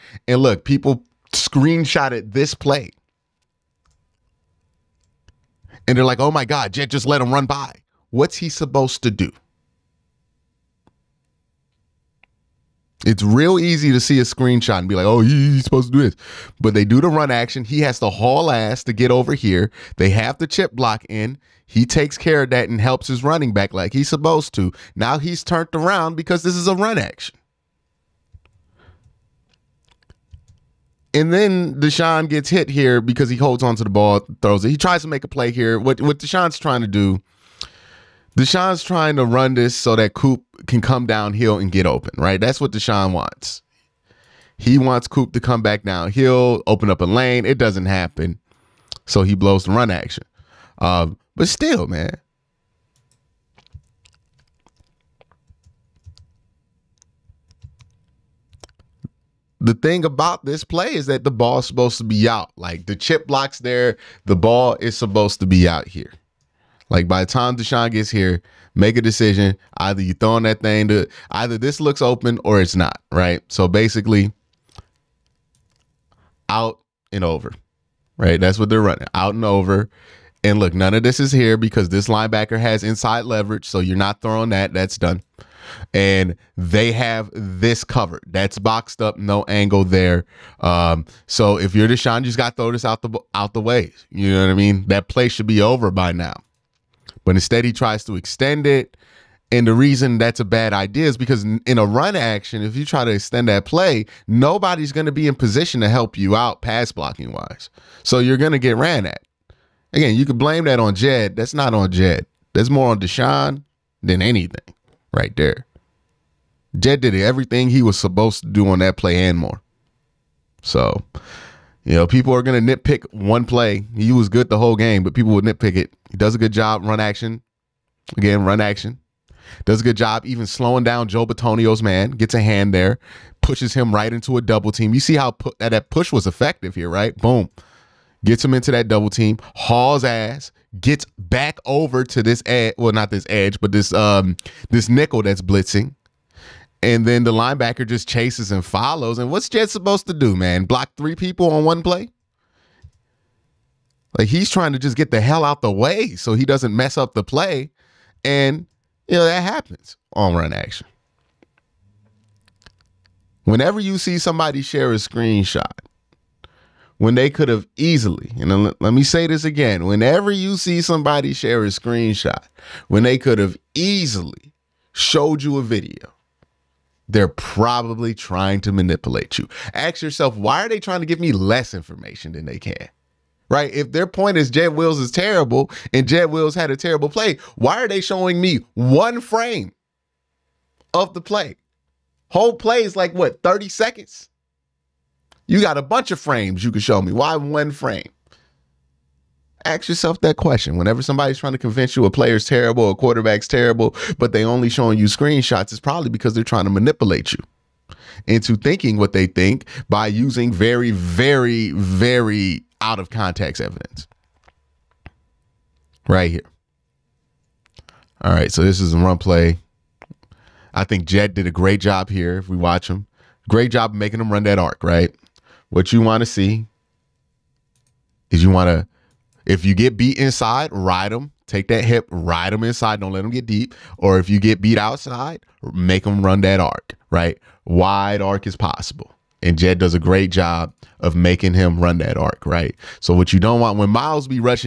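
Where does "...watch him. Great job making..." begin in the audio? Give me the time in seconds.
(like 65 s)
222 s.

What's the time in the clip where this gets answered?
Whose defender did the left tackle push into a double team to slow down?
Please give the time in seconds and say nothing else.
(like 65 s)
131 s.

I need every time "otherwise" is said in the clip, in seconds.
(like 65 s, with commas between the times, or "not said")
not said.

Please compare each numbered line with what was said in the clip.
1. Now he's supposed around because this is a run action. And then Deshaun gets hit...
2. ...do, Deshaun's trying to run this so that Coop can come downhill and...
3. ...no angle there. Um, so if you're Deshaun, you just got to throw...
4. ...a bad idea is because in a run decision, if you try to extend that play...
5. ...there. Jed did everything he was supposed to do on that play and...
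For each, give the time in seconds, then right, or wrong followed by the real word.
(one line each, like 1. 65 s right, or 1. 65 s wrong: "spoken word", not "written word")
1. 24 s wrong: "turned", not "supposed"
2. 36 s right
3. 89 s right
4. 100 s wrong: "action", not "decision"
5. 115 s right.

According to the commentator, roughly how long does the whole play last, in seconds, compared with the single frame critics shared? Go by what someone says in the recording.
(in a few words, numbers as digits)
30.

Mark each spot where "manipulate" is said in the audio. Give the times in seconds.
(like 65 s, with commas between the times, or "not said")
178 s, 206 s.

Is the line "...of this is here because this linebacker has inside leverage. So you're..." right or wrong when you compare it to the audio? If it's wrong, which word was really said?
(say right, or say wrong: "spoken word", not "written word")
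right.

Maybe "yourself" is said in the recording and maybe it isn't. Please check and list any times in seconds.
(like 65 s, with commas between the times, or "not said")
180 s, 199 s.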